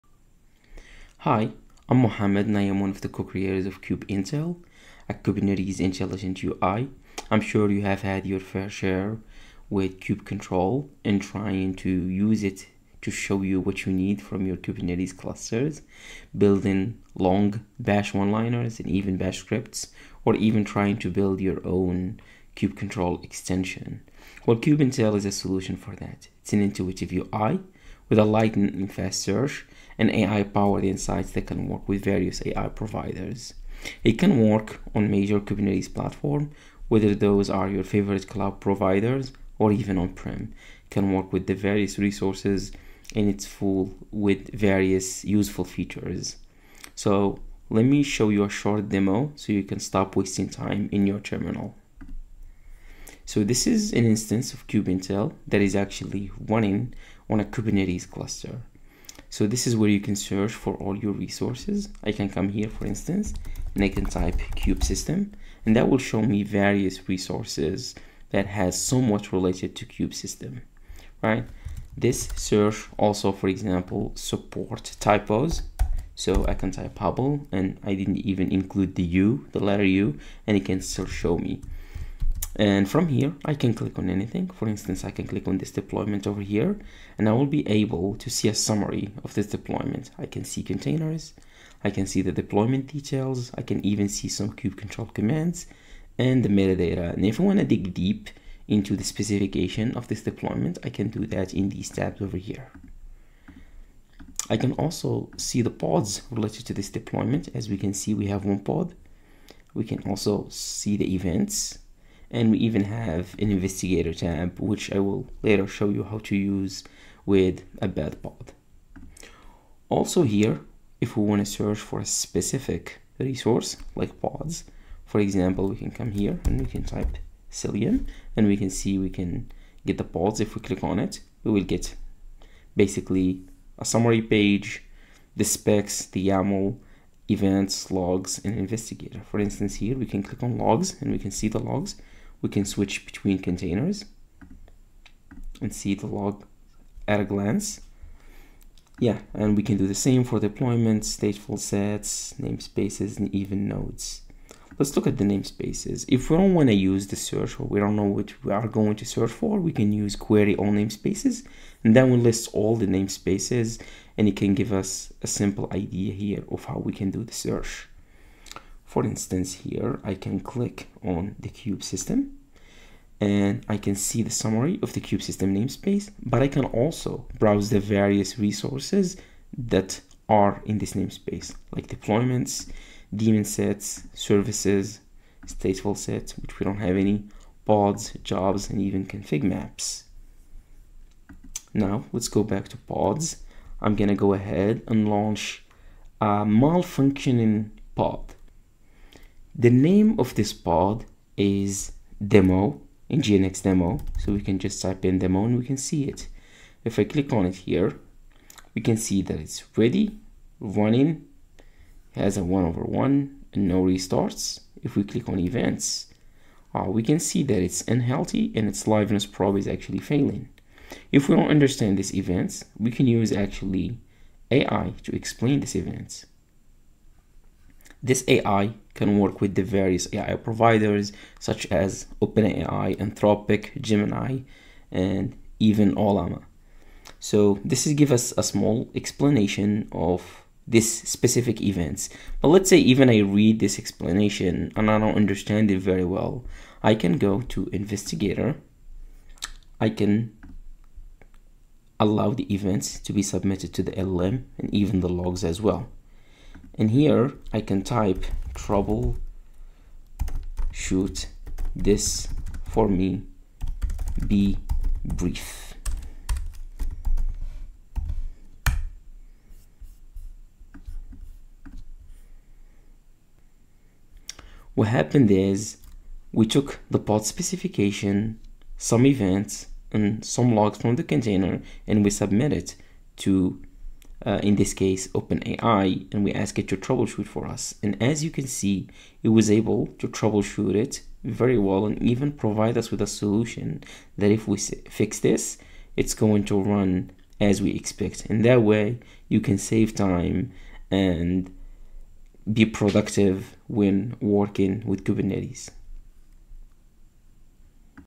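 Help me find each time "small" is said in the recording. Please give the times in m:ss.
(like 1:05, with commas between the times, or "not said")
3:58.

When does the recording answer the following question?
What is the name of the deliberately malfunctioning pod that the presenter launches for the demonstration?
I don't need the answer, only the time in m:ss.
3:22.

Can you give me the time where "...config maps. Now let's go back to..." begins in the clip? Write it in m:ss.
3:09.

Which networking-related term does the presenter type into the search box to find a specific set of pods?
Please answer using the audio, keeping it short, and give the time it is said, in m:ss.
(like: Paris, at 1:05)
Cilium, at 2:07.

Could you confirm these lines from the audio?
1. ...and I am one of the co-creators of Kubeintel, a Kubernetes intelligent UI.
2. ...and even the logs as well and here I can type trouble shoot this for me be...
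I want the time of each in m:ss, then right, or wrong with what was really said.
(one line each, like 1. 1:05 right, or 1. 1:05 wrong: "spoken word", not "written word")
1. 0:02 right
2. 4:14 right.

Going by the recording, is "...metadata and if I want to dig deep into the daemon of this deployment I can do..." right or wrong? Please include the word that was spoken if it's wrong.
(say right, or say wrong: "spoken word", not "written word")
wrong: "specification", not "daemon".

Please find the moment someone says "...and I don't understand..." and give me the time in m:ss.
4:04.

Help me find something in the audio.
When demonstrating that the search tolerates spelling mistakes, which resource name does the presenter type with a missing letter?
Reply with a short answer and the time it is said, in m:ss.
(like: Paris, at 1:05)
Hubble, at 1:16.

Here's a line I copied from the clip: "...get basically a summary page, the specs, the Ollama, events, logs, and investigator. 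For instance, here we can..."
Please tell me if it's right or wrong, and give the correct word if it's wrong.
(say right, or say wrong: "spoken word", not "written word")
wrong: "YAML", not "Ollama".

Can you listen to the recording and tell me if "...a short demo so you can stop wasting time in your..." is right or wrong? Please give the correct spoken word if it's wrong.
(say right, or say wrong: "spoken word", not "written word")
right.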